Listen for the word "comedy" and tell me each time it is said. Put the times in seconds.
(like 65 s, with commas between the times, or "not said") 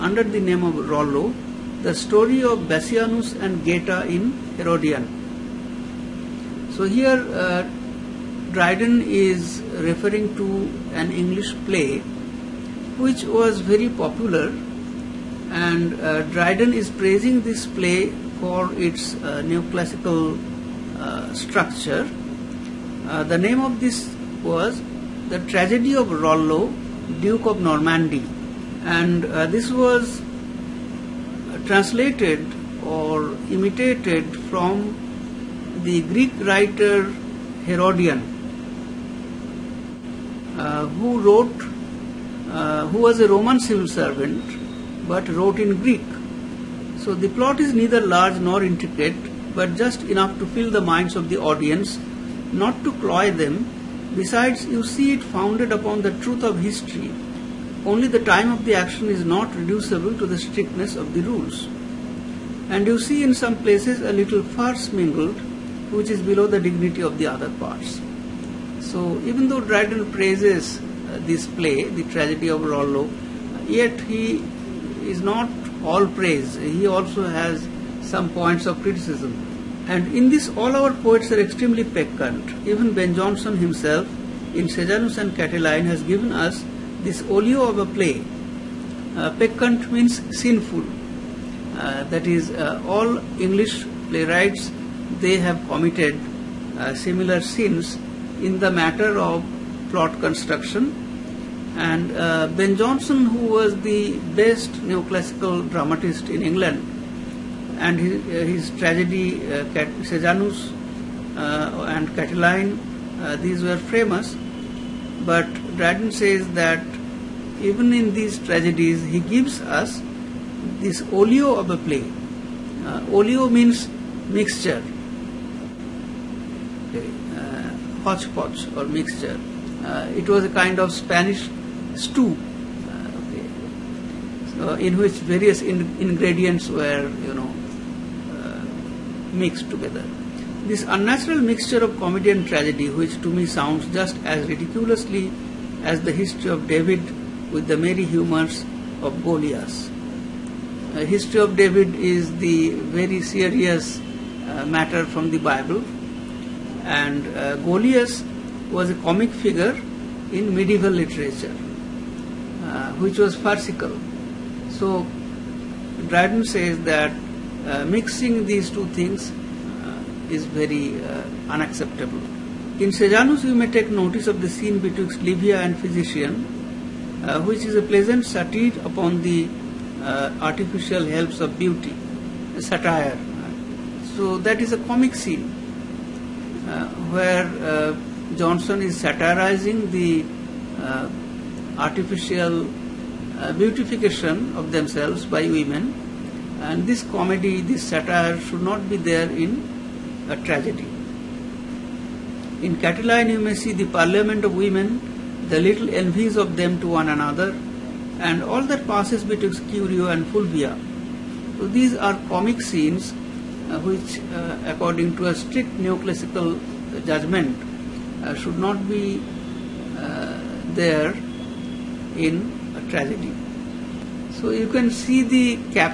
141 s, 197 s.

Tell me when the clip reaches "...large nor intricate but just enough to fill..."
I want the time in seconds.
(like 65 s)
47 s.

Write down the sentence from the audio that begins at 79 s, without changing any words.
And in this, all our poets are extremely peccant.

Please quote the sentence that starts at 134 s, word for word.
so in which various in ingredients were you know mixed together.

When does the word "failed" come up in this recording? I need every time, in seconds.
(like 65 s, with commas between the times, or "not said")
not said.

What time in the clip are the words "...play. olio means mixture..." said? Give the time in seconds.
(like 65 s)
121 s.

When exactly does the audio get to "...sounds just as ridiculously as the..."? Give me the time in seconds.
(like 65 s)
143 s.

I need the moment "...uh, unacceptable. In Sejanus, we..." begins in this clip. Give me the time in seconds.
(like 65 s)
171 s.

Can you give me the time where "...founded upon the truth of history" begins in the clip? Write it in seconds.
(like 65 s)
55 s.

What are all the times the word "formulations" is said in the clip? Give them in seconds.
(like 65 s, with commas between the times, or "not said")
not said.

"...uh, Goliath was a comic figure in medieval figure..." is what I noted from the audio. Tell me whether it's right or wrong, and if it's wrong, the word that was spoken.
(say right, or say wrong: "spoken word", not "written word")
wrong: "literature", not "figure".